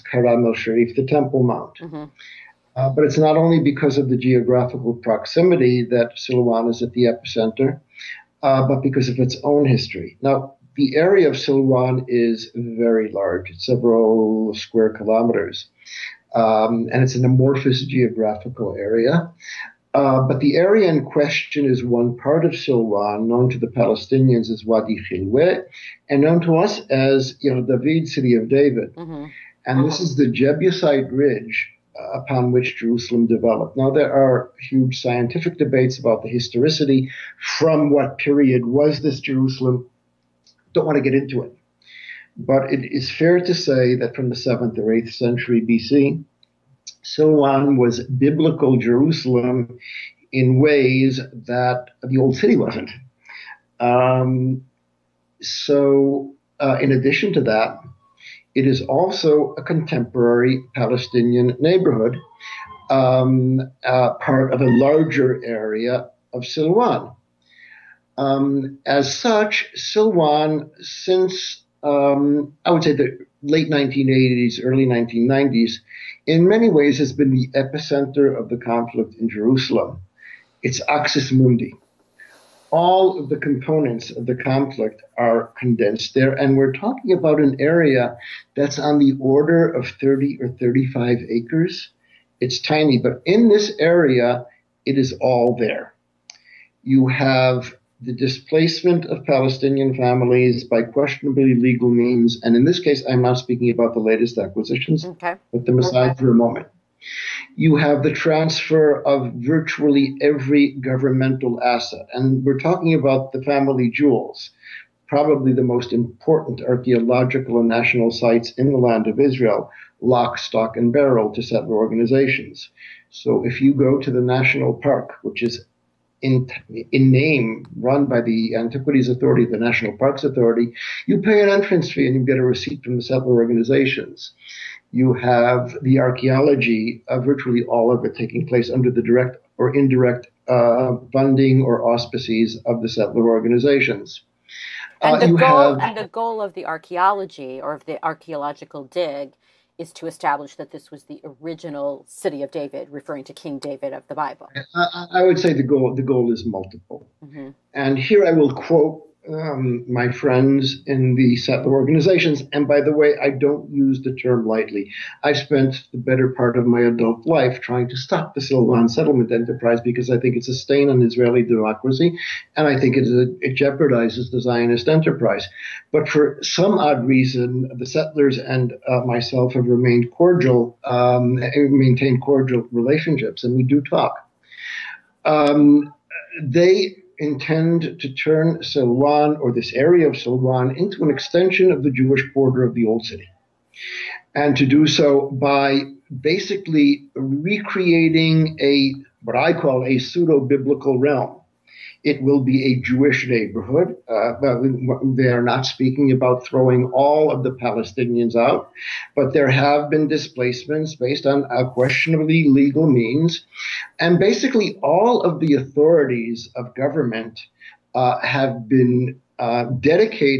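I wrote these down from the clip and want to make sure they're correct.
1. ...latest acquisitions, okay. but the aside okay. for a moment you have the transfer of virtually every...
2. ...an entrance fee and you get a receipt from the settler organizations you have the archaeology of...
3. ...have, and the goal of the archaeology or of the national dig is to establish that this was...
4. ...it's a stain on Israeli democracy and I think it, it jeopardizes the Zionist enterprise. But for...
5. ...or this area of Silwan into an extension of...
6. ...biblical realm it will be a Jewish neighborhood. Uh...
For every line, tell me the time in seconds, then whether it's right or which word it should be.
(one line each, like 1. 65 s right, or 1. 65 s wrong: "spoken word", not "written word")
1. 103 s right
2. 131 s right
3. 145 s wrong: "archaeological", not "national"
4. 170 s right
5. 189 s right
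6. 200 s right.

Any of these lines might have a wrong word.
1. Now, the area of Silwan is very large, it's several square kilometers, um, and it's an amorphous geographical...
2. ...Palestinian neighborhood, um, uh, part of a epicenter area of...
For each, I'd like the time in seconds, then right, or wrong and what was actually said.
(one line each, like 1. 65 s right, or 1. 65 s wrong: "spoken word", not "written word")
1. 10 s right
2. 60 s wrong: "larger", not "epicenter".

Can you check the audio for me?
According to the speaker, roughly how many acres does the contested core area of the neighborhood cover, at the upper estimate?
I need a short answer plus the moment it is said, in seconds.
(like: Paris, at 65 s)
35, at 90 s.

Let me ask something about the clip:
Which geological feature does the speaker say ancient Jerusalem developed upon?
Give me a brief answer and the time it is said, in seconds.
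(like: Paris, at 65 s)
The Jebusite Ridge, at 30 s.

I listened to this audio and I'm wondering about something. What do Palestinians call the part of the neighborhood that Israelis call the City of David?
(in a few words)
Wadi Khilwe.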